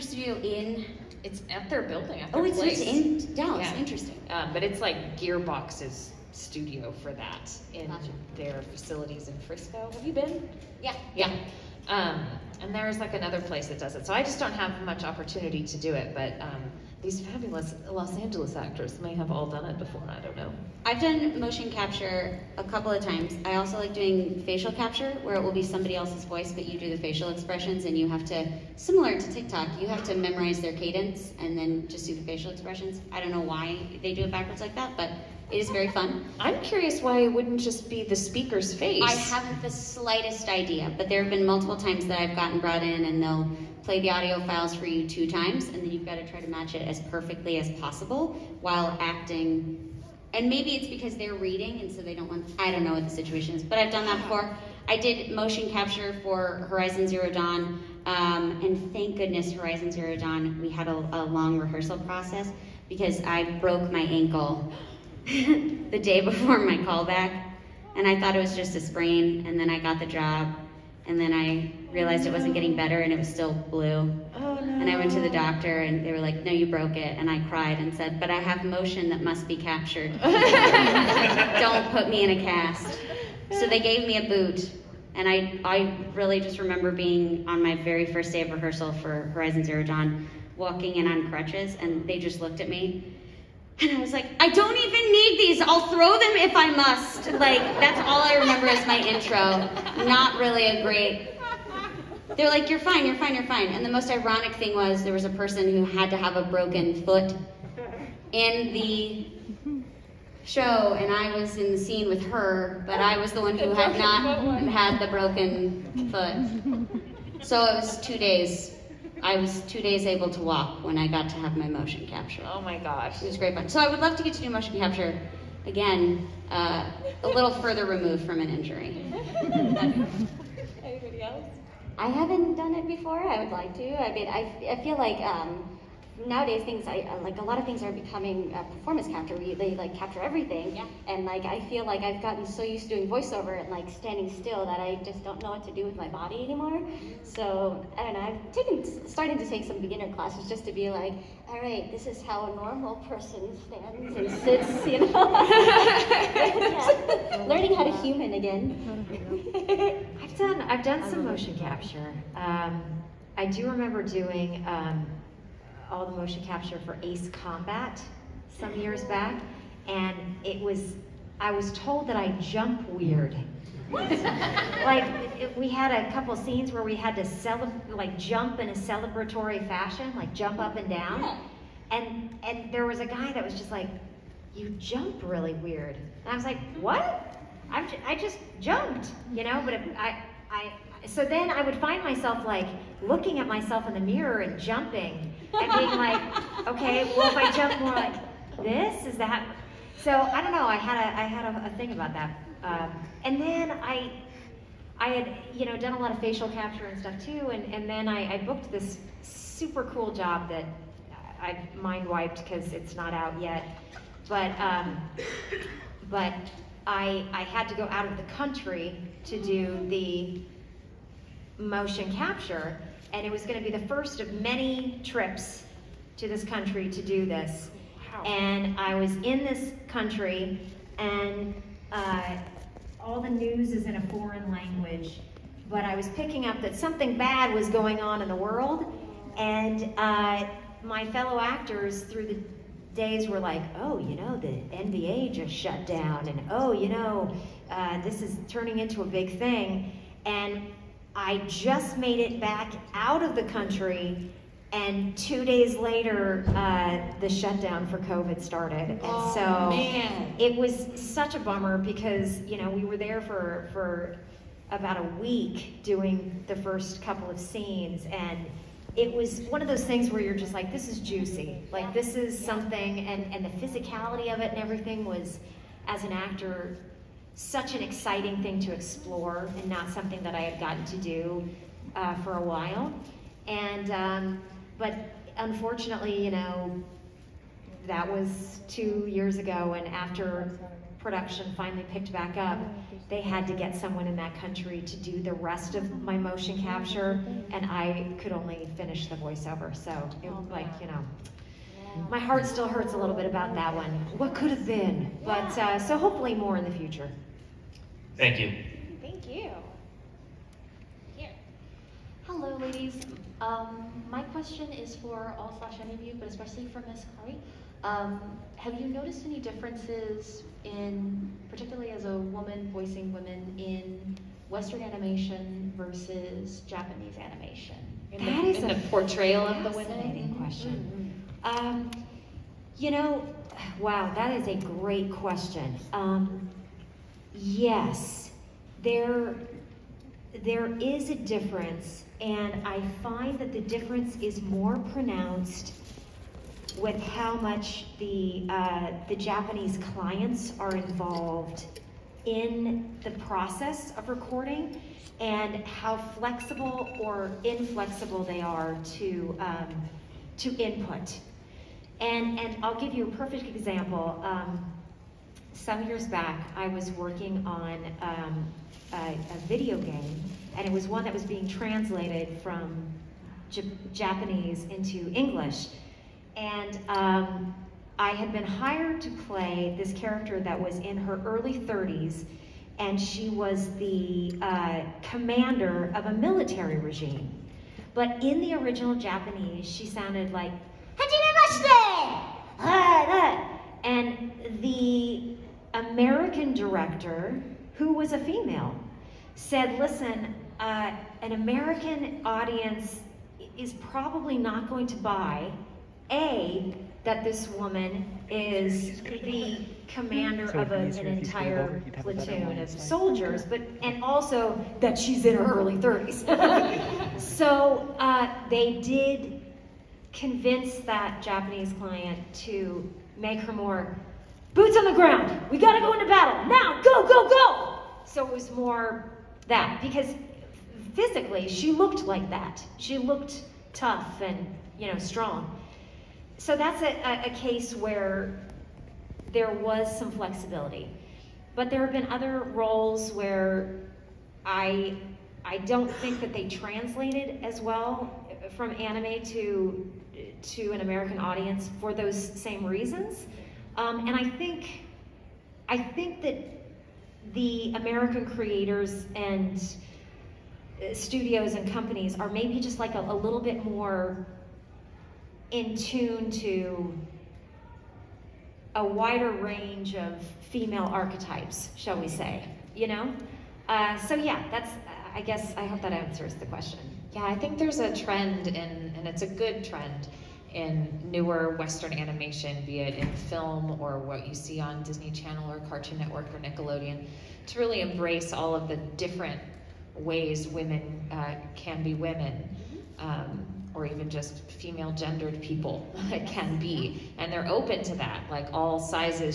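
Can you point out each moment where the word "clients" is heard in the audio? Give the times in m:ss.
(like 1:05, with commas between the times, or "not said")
5:49, 7:01.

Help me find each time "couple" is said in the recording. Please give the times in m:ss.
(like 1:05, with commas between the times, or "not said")
0:22, 2:56, 4:27.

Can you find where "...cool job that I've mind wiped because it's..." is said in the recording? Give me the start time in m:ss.
3:29.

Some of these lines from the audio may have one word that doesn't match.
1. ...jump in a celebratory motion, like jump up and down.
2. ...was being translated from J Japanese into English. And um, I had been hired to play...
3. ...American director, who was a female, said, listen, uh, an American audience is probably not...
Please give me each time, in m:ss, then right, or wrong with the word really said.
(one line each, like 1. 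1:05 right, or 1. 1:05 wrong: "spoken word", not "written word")
1. 2:58 wrong: "fashion", not "motion"
2. 6:11 right
3. 6:35 right.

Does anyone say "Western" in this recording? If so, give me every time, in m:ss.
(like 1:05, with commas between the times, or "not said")
5:24, 8:01.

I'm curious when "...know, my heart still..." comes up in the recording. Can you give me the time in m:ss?
5:00.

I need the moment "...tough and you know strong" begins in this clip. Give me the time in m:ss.
7:13.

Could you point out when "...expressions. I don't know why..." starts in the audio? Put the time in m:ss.
0:32.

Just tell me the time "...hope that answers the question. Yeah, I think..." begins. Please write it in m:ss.
7:55.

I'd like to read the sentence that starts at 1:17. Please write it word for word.
And I cried and said, but I have motion that must be captured.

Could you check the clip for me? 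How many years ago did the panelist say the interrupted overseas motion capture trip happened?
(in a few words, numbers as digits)
2 years.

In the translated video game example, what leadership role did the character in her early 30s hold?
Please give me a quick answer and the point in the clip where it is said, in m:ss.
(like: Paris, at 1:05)
Commander of a military regime, at 6:25.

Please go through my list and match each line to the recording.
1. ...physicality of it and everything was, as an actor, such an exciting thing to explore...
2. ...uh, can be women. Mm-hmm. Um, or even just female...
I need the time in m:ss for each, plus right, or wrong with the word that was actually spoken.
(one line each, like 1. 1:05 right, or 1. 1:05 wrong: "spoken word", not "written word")
1. 4:33 right
2. 8:11 right.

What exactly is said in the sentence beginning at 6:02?
And, and I'll give you a perfect example.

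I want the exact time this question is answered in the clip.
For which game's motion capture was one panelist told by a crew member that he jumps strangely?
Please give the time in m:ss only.
2:47.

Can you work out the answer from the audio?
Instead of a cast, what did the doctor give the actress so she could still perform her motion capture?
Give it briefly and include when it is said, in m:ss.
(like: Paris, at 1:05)
A boot, at 1:24.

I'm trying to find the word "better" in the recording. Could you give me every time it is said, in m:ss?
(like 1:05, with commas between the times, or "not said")
1:12.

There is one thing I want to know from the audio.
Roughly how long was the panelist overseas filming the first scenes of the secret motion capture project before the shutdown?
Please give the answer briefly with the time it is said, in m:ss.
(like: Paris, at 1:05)
About a week, at 4:24.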